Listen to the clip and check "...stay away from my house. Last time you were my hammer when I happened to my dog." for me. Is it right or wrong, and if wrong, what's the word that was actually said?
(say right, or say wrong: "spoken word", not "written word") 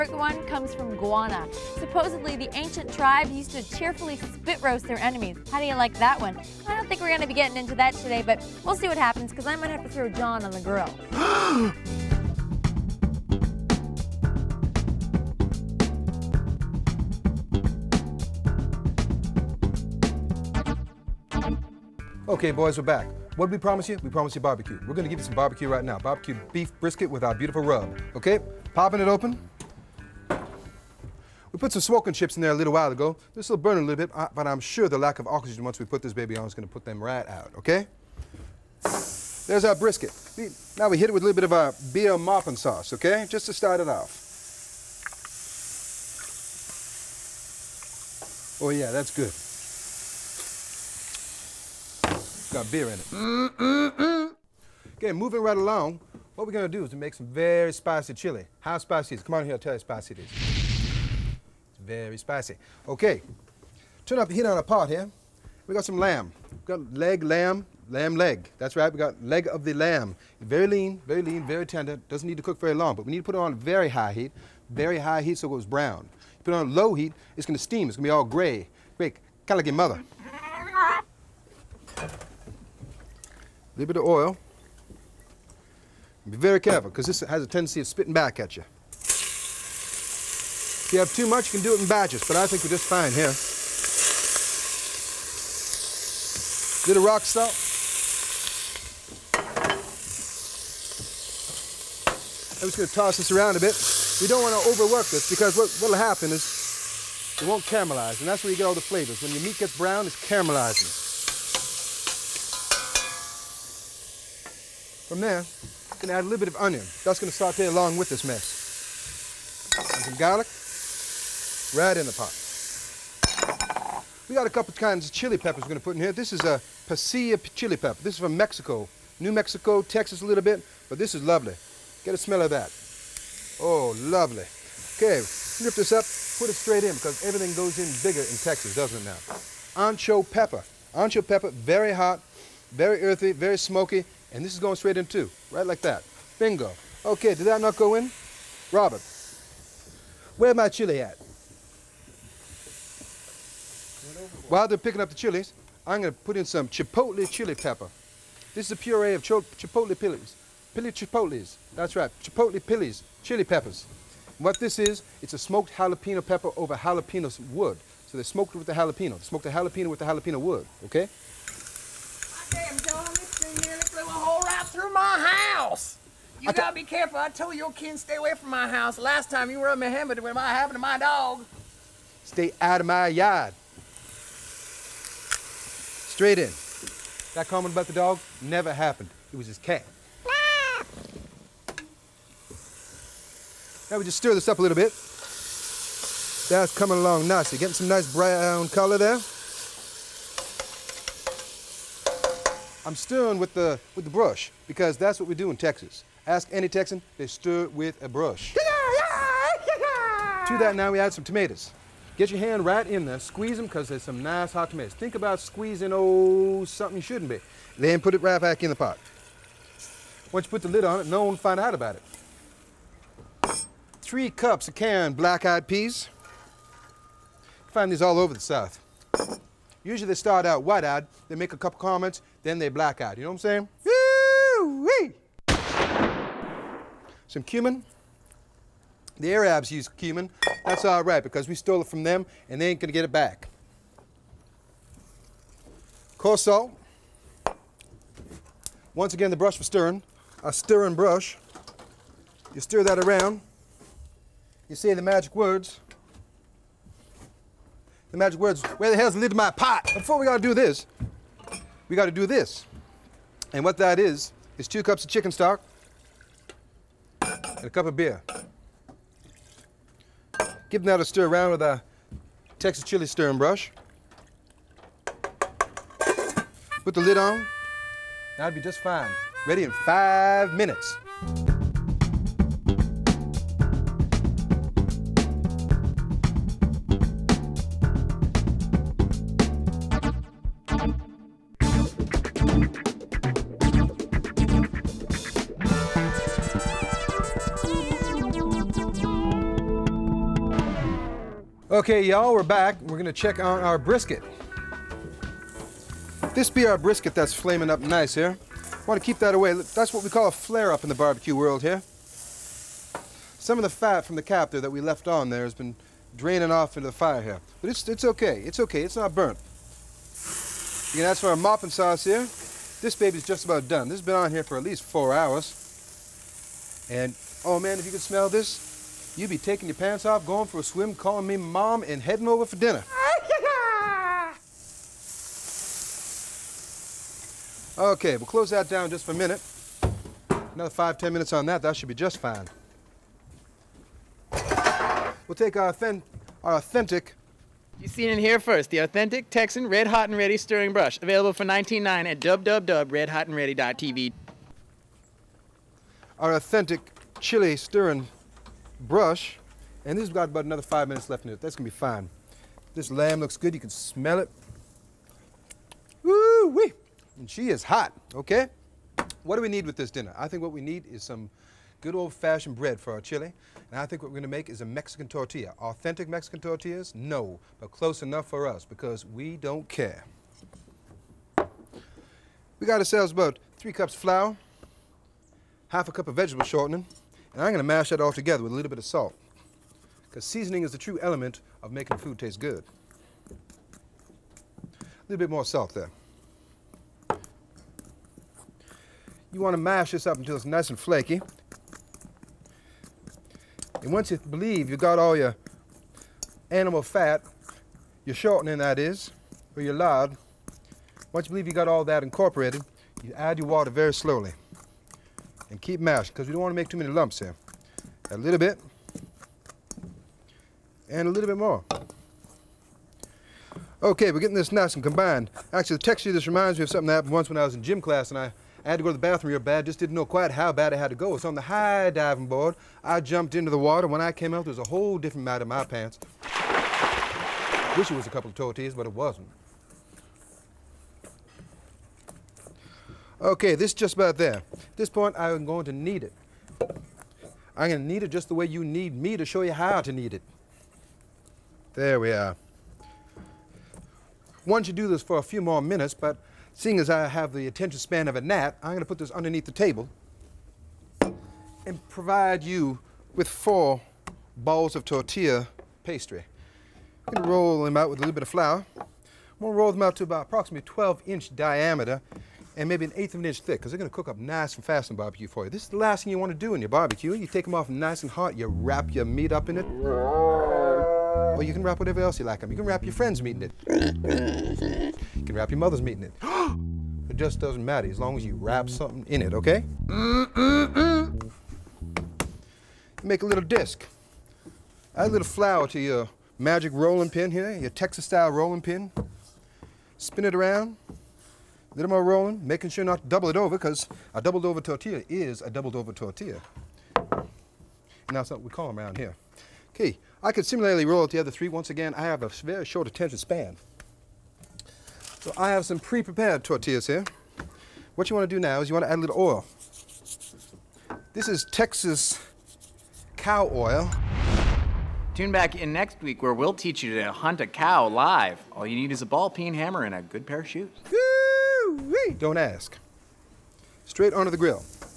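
right.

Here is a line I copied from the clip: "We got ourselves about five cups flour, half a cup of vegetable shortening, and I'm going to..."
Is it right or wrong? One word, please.
wrong.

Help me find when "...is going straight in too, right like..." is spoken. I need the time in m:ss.
2:24.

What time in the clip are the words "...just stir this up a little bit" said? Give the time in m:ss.
3:14.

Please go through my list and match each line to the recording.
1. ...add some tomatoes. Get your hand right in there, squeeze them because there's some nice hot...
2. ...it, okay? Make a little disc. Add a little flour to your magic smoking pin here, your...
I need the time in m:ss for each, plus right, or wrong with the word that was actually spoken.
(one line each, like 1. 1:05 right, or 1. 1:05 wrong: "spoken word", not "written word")
1. 3:30 right
2. 8:09 wrong: "rolling", not "smoking".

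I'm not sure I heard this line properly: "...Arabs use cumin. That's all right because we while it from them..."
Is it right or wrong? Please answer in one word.
wrong.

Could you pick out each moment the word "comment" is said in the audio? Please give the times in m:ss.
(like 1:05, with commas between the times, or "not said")
3:07, 3:51.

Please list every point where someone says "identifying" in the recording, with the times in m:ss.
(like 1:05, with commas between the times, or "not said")
not said.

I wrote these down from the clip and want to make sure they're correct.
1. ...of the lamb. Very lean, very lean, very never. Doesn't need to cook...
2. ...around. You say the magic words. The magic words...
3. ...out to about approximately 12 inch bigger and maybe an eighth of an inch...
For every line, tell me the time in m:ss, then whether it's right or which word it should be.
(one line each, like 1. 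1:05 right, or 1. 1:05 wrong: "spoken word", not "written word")
1. 1:09 wrong: "tender", not "never"
2. 4:12 right
3. 7:49 wrong: "diameter", not "bigger".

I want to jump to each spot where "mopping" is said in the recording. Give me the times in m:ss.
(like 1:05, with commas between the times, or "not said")
0:42, 5:21.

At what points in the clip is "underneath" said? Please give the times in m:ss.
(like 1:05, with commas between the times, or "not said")
7:39.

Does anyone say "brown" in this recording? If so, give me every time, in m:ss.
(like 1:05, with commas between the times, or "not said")
1:15, 1:49, 3:18.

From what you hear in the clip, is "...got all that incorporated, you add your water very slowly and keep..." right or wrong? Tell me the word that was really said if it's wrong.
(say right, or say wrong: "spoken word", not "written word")
right.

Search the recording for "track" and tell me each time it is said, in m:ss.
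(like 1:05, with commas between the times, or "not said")
not said.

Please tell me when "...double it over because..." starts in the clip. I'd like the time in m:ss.
8:23.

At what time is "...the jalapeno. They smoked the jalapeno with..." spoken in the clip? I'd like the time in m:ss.
2:48.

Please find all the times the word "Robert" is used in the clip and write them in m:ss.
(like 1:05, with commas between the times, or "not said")
2:28.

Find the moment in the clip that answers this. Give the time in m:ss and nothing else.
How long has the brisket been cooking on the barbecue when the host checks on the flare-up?
5:24.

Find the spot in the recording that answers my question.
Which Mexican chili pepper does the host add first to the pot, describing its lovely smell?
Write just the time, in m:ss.
2:06.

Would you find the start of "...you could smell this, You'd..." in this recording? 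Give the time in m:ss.
5:27.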